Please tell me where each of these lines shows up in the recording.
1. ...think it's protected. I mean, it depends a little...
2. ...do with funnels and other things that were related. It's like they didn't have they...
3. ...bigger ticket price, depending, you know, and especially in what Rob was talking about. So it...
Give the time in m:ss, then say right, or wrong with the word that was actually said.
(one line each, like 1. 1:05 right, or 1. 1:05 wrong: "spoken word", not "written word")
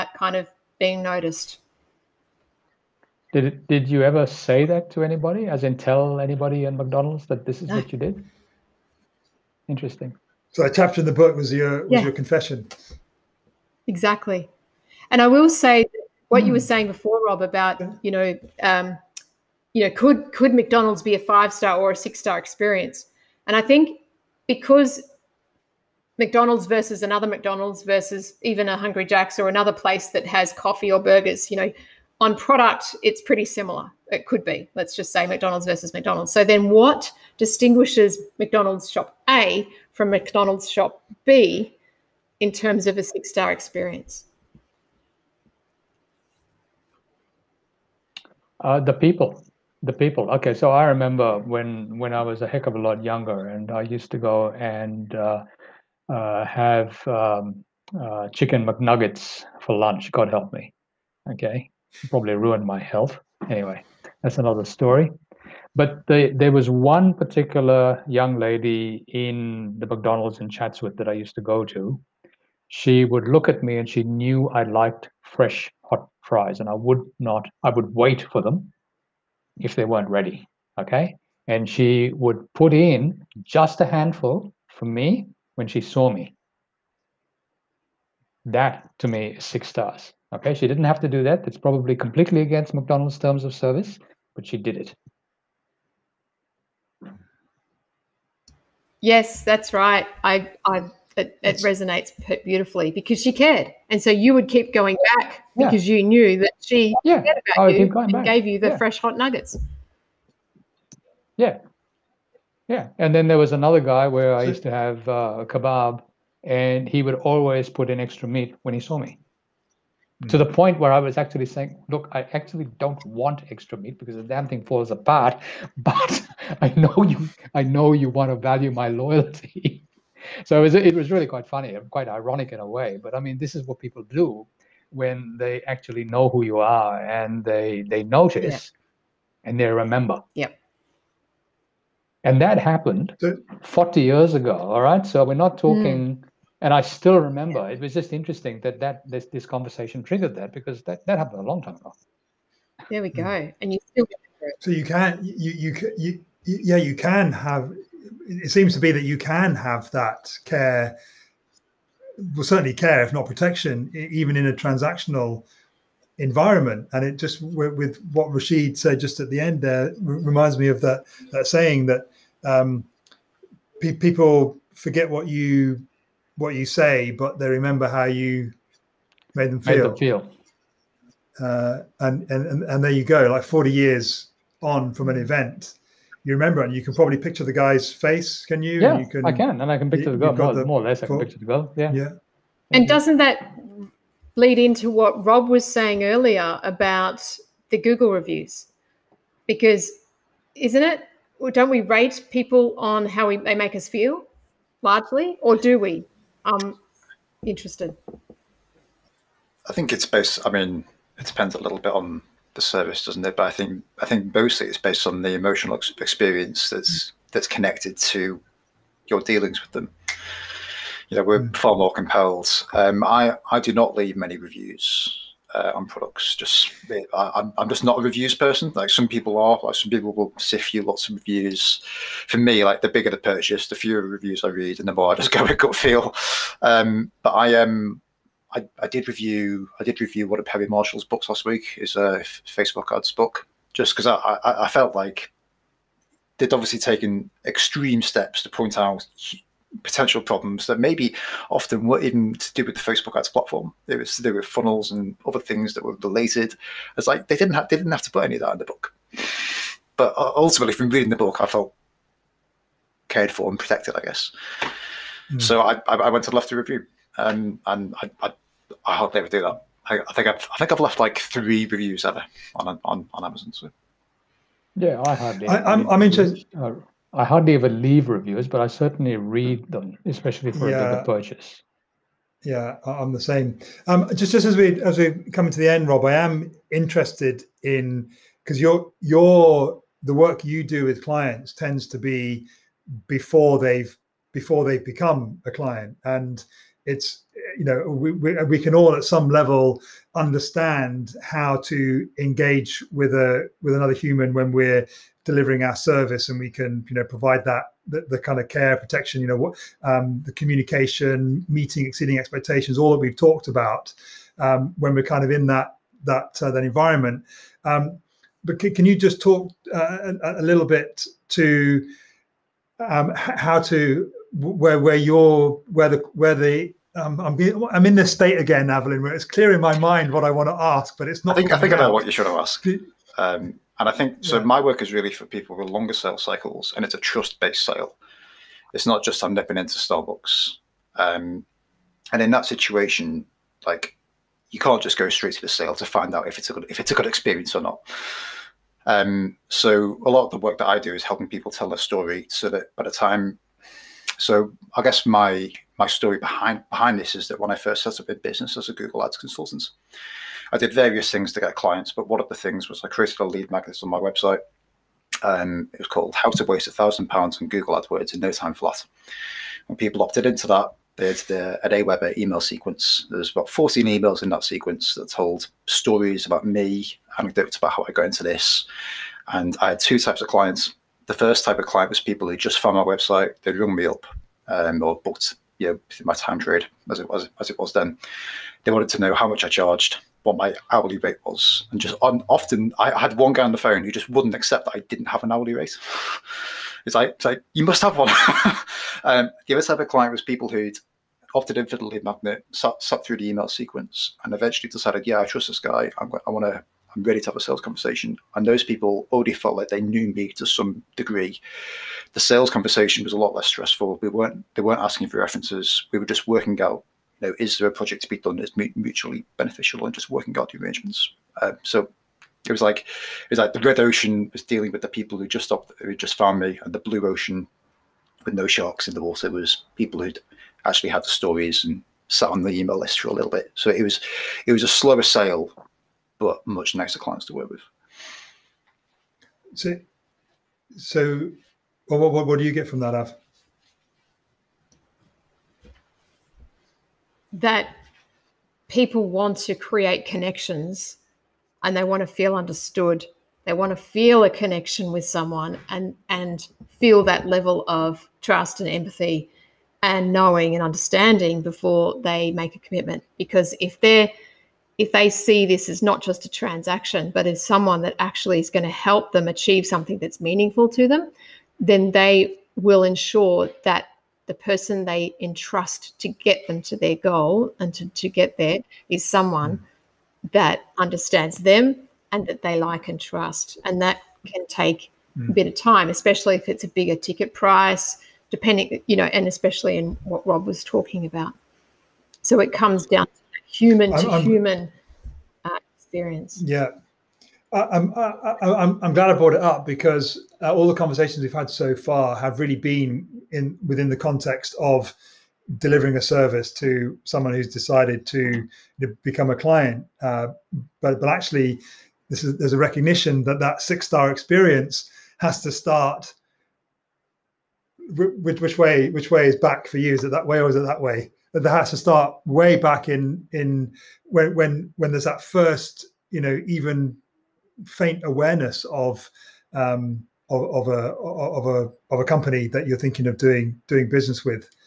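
1. 3:29 wrong: "based", not "protected"
2. 4:14 right
3. 8:06 right.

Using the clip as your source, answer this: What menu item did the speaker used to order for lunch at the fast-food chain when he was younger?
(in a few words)
chicken McNuggets.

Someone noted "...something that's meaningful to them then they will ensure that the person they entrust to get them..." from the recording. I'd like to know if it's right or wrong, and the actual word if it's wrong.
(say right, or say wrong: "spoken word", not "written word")
right.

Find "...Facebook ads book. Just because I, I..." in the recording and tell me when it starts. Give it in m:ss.
4:02.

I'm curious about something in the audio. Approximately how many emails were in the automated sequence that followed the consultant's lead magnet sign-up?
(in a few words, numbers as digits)
14.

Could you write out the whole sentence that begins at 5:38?
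It's not just I'm nipping into Starbucks.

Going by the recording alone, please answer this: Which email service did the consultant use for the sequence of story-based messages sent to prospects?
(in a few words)
AWeber.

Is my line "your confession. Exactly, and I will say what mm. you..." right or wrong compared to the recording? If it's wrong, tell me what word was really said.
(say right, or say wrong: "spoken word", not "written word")
right.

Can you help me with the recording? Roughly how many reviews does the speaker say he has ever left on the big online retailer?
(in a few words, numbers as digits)
3.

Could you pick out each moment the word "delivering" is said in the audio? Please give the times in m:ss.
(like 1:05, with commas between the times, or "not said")
5:05, 8:25.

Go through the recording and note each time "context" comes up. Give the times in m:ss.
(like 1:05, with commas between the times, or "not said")
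8:23.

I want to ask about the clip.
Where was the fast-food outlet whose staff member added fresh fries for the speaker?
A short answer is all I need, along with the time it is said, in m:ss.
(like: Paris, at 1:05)
Chatsworth, at 1:10.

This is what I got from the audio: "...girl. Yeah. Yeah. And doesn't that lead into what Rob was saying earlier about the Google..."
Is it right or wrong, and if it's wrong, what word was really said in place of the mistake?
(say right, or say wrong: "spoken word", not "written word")
right.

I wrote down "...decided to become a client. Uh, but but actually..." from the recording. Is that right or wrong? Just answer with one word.
right.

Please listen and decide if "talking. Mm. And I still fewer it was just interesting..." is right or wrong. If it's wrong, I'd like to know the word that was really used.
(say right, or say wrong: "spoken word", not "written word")
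wrong: "remember", not "fewer".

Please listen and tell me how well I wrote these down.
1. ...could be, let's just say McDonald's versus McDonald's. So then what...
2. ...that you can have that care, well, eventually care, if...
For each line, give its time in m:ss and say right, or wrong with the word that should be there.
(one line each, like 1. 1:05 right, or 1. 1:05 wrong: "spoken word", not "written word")
1. 0:34 right
2. 2:38 wrong: "certainly", not "eventually".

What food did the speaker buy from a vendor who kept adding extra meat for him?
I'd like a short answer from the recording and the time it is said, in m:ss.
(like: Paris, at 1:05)
kebab, at 1:55.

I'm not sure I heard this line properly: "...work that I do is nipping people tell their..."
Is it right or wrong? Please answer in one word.
wrong.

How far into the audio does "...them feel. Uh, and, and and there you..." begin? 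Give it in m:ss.
2:59.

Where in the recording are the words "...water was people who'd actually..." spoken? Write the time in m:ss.
7:09.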